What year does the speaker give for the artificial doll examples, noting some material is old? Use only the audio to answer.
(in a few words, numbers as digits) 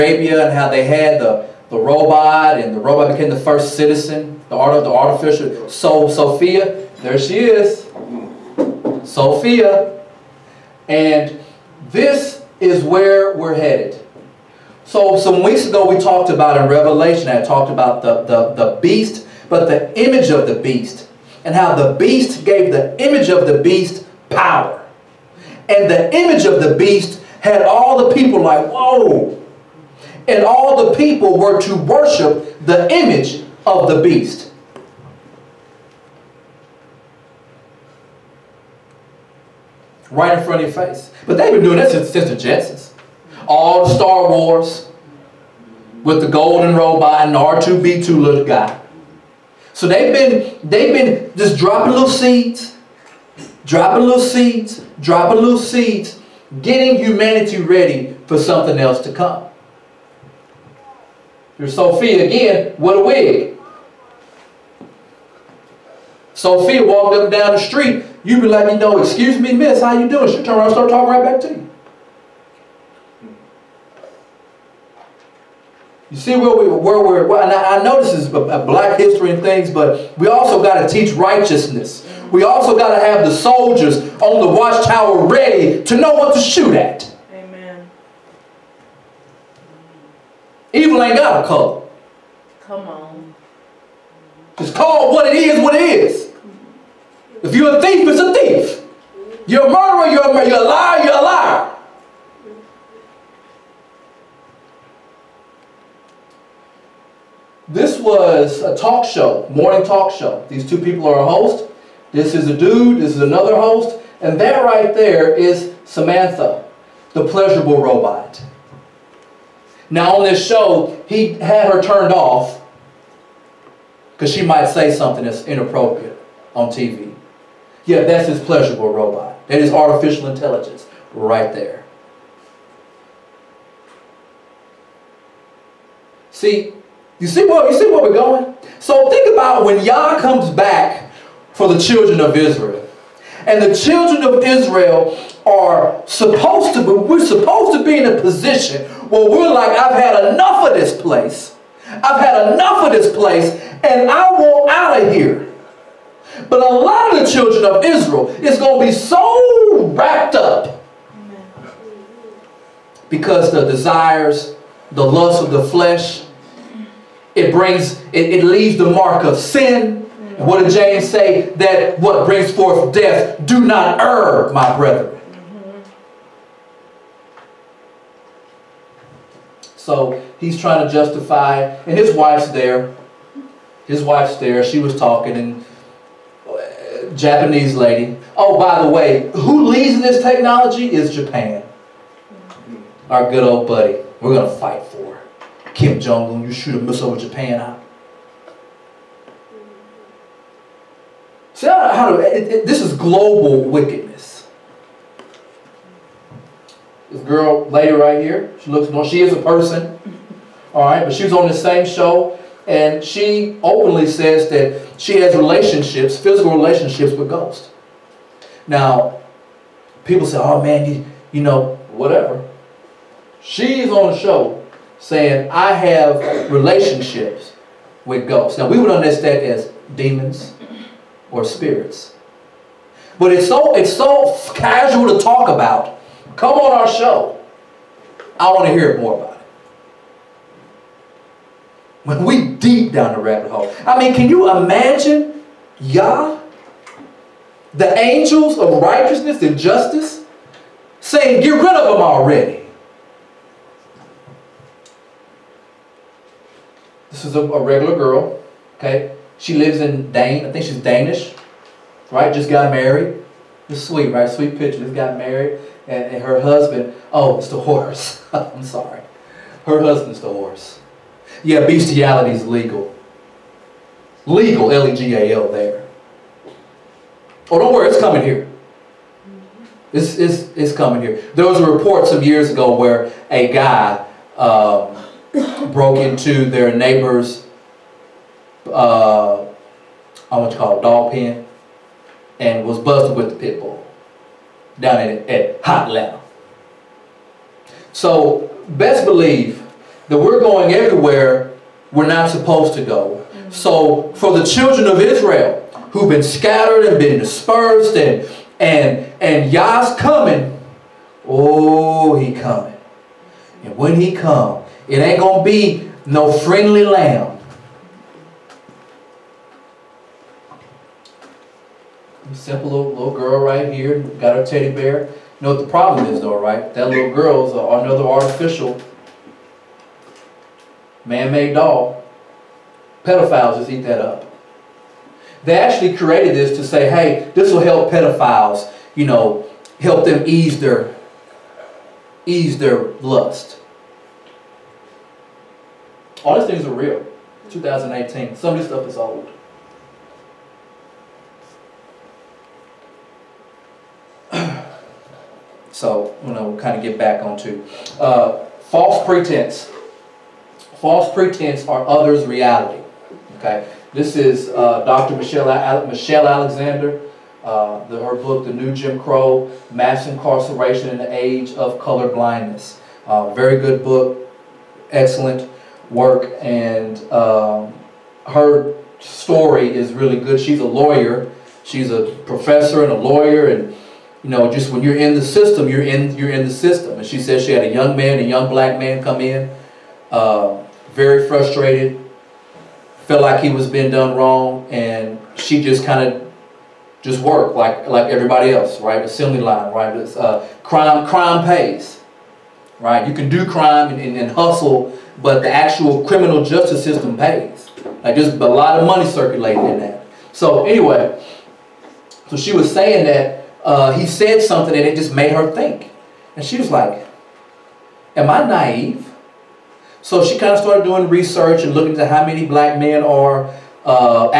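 2018.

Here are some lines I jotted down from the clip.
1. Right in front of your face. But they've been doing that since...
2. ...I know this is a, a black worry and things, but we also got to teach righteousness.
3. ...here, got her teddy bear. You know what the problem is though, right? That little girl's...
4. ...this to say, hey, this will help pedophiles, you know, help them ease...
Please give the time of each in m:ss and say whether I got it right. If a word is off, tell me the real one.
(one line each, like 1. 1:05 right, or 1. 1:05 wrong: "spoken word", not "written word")
1. 0:40 right
2. 1:17 wrong: "history", not "worry"
3. 5:23 right
4. 5:36 right.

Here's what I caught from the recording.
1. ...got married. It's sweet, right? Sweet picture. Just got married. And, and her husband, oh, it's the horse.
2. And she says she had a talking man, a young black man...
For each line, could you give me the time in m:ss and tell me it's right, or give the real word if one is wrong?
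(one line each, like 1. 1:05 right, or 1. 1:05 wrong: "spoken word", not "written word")
1. 4:22 right
2. 6:26 wrong: "young", not "talking".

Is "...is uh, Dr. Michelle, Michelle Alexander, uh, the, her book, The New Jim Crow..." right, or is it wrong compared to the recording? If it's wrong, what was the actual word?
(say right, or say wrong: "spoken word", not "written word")
right.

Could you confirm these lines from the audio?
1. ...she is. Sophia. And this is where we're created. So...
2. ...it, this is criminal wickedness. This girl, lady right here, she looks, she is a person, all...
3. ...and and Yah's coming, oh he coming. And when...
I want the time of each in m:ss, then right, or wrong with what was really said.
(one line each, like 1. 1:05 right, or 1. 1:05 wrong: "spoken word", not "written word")
1. 0:07 wrong: "headed", not "created"
2. 3:22 wrong: "global", not "criminal"
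3. 5:08 right.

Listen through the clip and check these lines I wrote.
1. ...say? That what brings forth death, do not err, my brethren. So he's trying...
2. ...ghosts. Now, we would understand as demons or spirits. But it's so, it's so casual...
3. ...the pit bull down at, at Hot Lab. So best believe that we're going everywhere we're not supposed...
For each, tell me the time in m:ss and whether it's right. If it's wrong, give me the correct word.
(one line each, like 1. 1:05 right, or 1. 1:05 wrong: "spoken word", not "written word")
1. 2:51 right
2. 3:48 right
3. 4:53 right.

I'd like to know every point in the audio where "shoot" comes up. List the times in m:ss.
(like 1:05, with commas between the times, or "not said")
1:26, 3:16.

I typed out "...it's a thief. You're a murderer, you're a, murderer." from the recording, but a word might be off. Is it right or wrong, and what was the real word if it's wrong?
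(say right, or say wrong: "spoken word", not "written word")
right.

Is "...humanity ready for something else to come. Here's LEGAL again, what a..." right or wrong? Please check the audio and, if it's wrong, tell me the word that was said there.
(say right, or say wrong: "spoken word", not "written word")
wrong: "Sophia", not "LEGAL".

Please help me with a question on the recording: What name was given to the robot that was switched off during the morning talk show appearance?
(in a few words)
Samantha.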